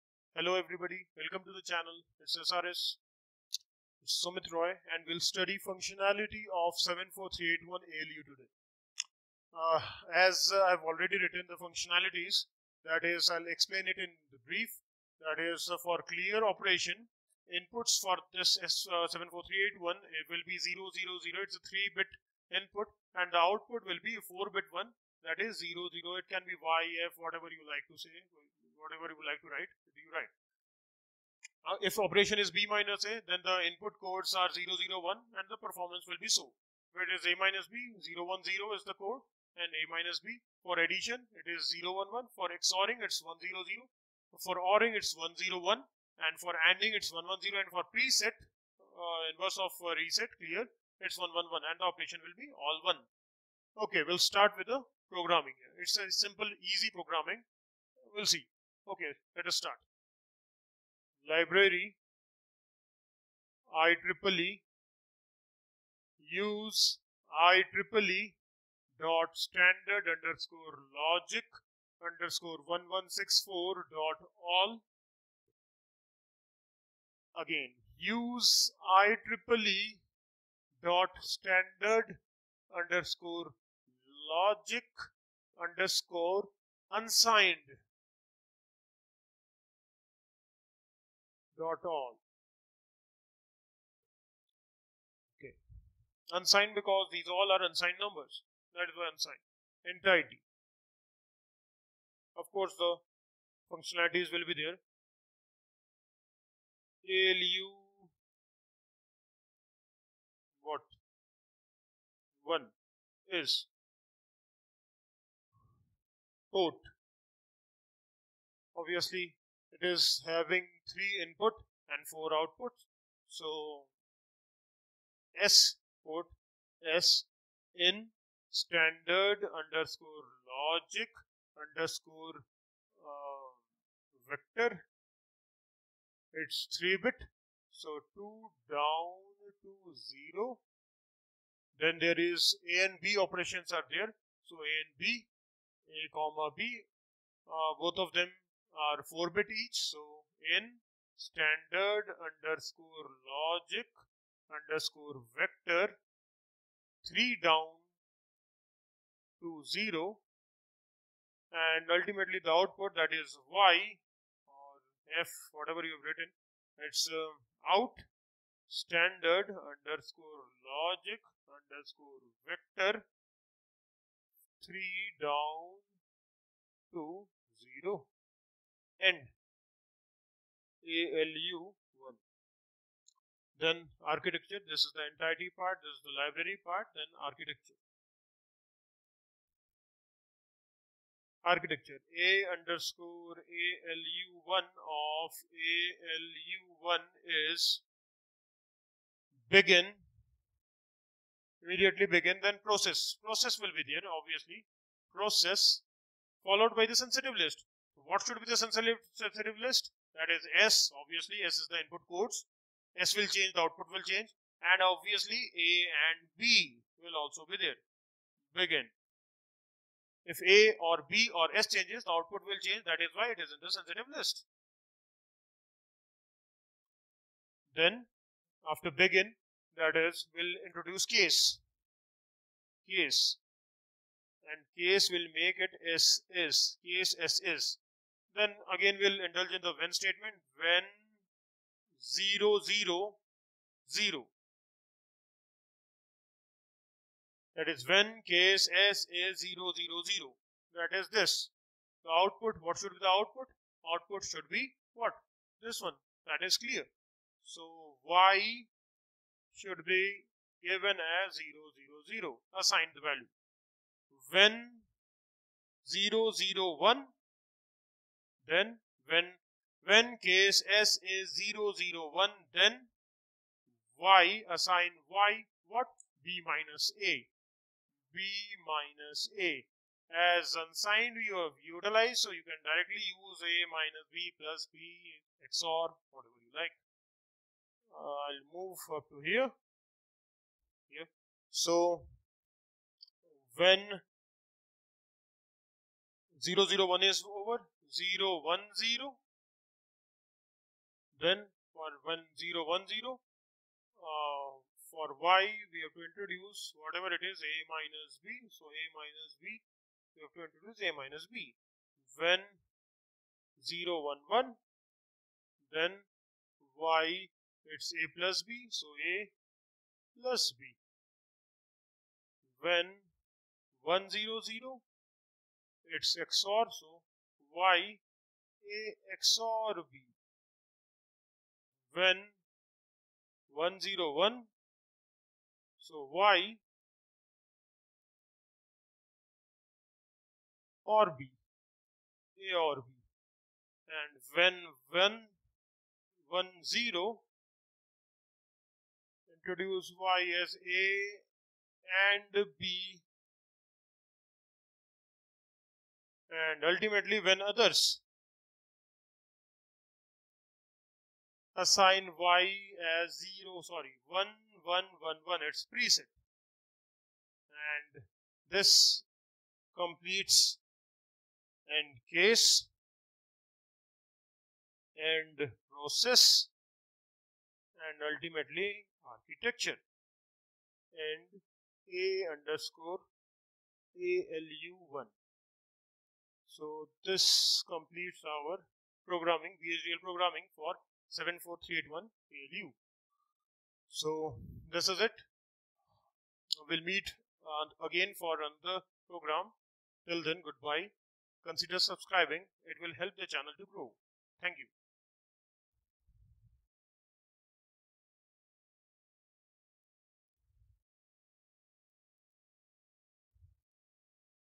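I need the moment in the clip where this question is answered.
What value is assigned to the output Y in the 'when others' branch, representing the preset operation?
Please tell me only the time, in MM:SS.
06:04.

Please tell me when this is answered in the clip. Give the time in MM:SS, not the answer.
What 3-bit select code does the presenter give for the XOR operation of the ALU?
00:43.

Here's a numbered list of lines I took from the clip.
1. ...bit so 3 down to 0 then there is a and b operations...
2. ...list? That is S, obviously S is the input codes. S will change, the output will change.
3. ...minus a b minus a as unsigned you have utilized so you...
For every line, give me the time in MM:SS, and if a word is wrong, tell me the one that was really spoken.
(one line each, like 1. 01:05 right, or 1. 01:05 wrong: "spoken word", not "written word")
1. 02:17 wrong: "2", not "3"
2. 03:29 right
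3. 04:36 right.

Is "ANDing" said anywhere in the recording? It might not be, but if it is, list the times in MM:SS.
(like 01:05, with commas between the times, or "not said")
00:46.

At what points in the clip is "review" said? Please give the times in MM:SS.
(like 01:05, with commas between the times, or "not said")
not said.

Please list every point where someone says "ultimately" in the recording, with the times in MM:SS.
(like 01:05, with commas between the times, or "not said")
02:41, 05:56, 06:18.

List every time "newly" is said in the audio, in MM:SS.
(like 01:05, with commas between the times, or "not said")
not said.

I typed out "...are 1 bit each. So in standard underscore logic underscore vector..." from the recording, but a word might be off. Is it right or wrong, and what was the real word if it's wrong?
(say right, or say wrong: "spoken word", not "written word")
wrong: "4", not "1".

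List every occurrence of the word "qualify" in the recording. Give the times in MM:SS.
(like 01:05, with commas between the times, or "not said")
not said.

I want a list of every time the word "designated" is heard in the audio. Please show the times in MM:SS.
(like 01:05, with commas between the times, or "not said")
not said.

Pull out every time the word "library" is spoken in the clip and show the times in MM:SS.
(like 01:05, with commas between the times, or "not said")
01:01, 03:06.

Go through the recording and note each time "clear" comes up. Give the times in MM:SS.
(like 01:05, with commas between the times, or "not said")
00:16, 00:50, 04:16.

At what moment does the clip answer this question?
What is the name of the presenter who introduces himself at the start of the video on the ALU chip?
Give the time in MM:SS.
00:04.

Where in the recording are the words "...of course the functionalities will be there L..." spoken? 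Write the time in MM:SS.
01:42.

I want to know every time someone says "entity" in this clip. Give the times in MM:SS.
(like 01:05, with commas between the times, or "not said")
01:39, 03:05.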